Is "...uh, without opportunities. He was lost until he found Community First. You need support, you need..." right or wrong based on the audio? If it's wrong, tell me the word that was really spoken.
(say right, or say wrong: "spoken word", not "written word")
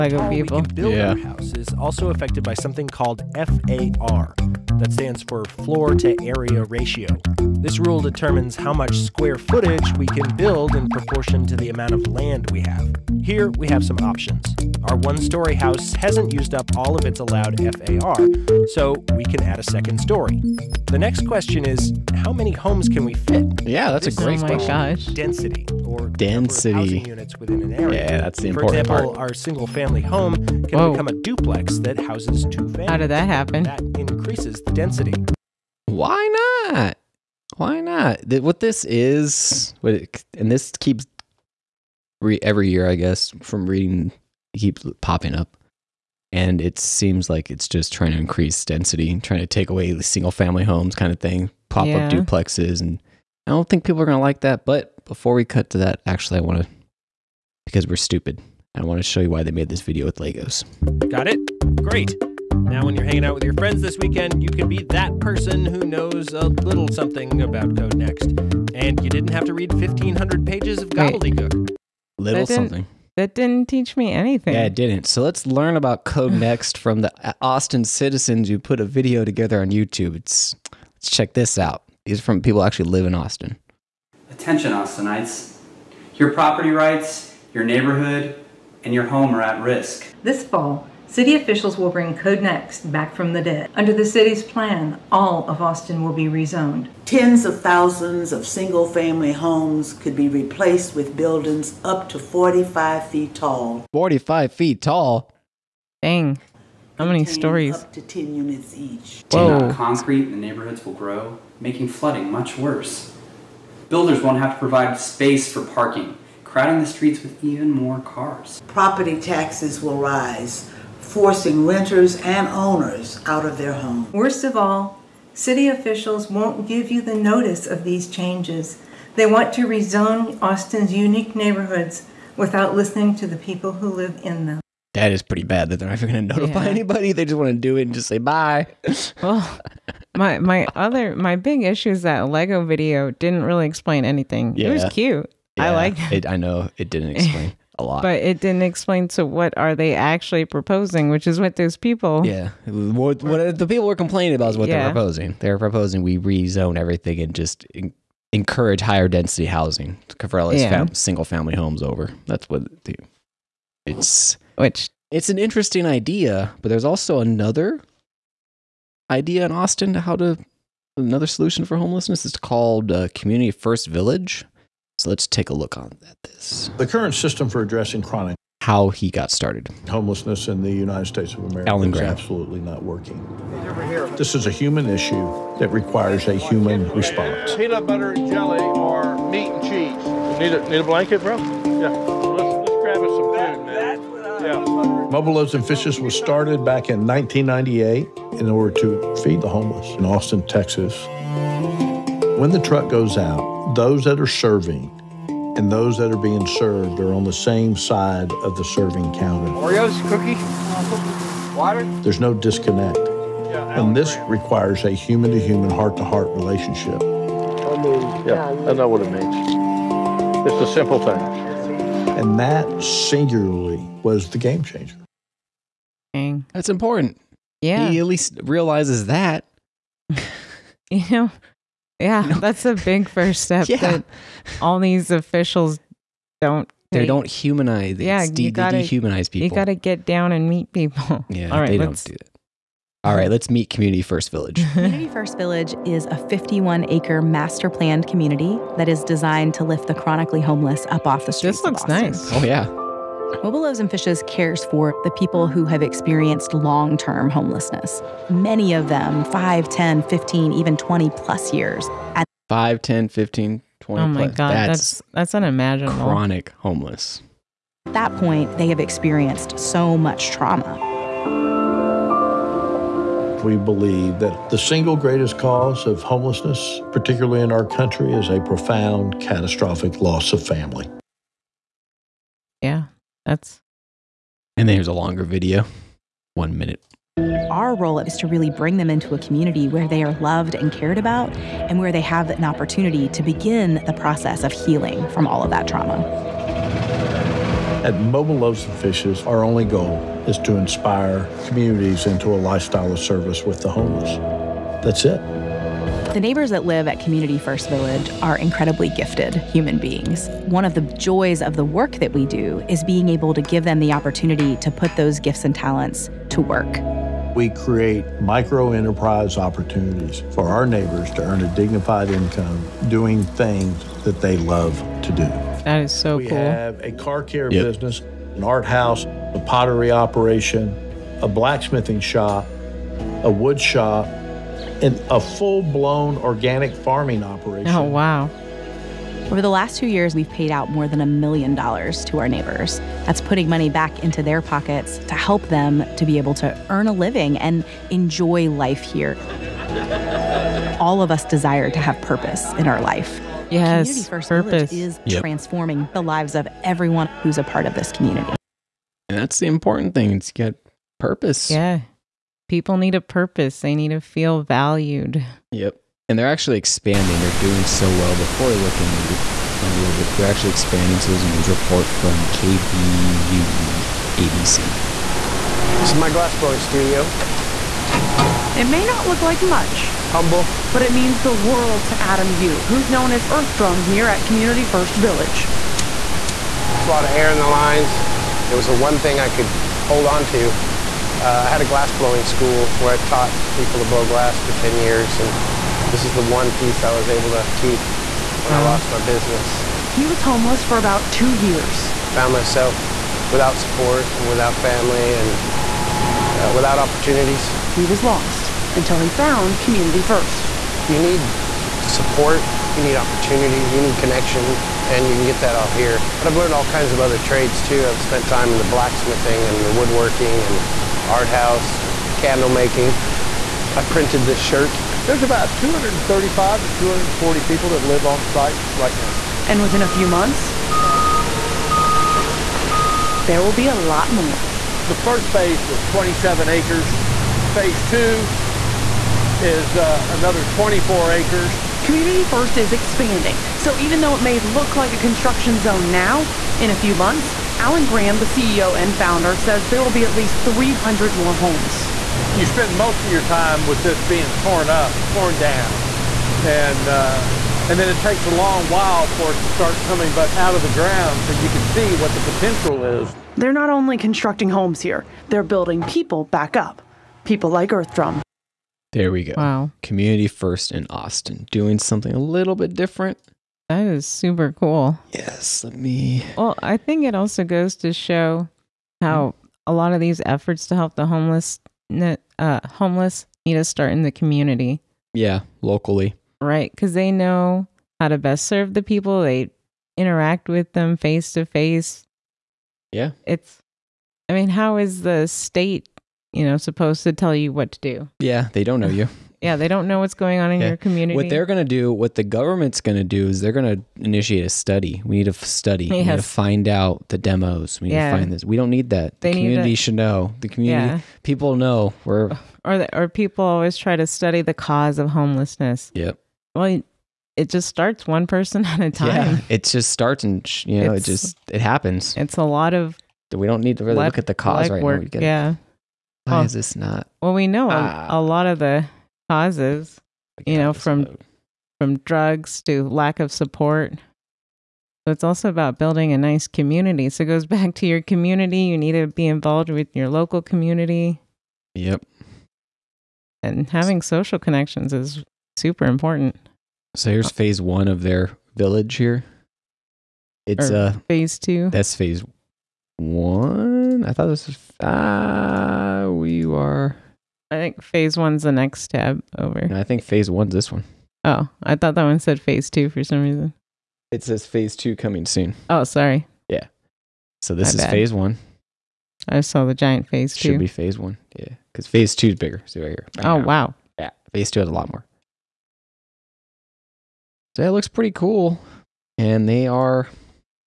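right.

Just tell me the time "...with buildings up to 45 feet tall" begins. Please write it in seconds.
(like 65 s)
100 s.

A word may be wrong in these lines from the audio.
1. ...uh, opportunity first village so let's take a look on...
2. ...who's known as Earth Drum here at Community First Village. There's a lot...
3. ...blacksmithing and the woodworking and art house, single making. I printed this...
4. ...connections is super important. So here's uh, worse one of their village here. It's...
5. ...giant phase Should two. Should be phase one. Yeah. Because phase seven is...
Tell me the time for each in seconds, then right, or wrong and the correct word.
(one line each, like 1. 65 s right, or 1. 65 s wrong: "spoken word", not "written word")
1. 172 s wrong: "community", not "opportunity"
2. 382 s right
3. 418 s wrong: "candle", not "single"
4. 544 s wrong: "phase", not "worse"
5. 569 s wrong: "two", not "seven".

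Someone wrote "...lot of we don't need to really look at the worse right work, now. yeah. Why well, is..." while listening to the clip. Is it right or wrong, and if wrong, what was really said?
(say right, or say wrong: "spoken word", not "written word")
wrong: "cause", not "worse".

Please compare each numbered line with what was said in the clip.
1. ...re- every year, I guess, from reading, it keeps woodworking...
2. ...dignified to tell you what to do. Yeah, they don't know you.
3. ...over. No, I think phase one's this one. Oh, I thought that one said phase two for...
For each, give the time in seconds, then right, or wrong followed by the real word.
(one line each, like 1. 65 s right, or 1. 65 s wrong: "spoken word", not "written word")
1. 42 s wrong: "popping", not "woodworking"
2. 496 s wrong: "supposed", not "dignified"
3. 559 s right.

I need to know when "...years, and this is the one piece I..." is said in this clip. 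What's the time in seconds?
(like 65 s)
394 s.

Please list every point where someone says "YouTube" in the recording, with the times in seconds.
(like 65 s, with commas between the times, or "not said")
79 s.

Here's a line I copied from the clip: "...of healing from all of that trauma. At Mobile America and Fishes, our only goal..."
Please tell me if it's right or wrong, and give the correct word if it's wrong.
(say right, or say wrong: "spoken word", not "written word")
wrong: "Loaves", not "America".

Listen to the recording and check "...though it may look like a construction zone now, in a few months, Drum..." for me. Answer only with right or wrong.
wrong.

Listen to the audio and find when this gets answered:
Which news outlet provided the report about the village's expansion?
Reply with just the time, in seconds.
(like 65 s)
372 s.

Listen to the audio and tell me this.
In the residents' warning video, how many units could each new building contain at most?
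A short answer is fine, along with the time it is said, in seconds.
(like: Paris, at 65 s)
10, at 107 s.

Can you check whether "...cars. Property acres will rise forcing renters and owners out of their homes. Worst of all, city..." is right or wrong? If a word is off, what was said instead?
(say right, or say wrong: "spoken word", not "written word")
wrong: "taxes", not "acres".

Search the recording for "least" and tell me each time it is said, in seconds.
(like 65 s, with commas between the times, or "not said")
228 s, 450 s.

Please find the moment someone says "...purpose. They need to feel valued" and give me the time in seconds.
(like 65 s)
363 s.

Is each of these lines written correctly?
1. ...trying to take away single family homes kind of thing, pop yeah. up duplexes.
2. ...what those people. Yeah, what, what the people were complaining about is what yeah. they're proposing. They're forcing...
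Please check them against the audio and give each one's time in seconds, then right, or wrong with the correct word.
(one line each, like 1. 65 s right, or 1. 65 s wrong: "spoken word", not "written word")
1. 49 s right
2. 151 s wrong: "proposing", not "forcing".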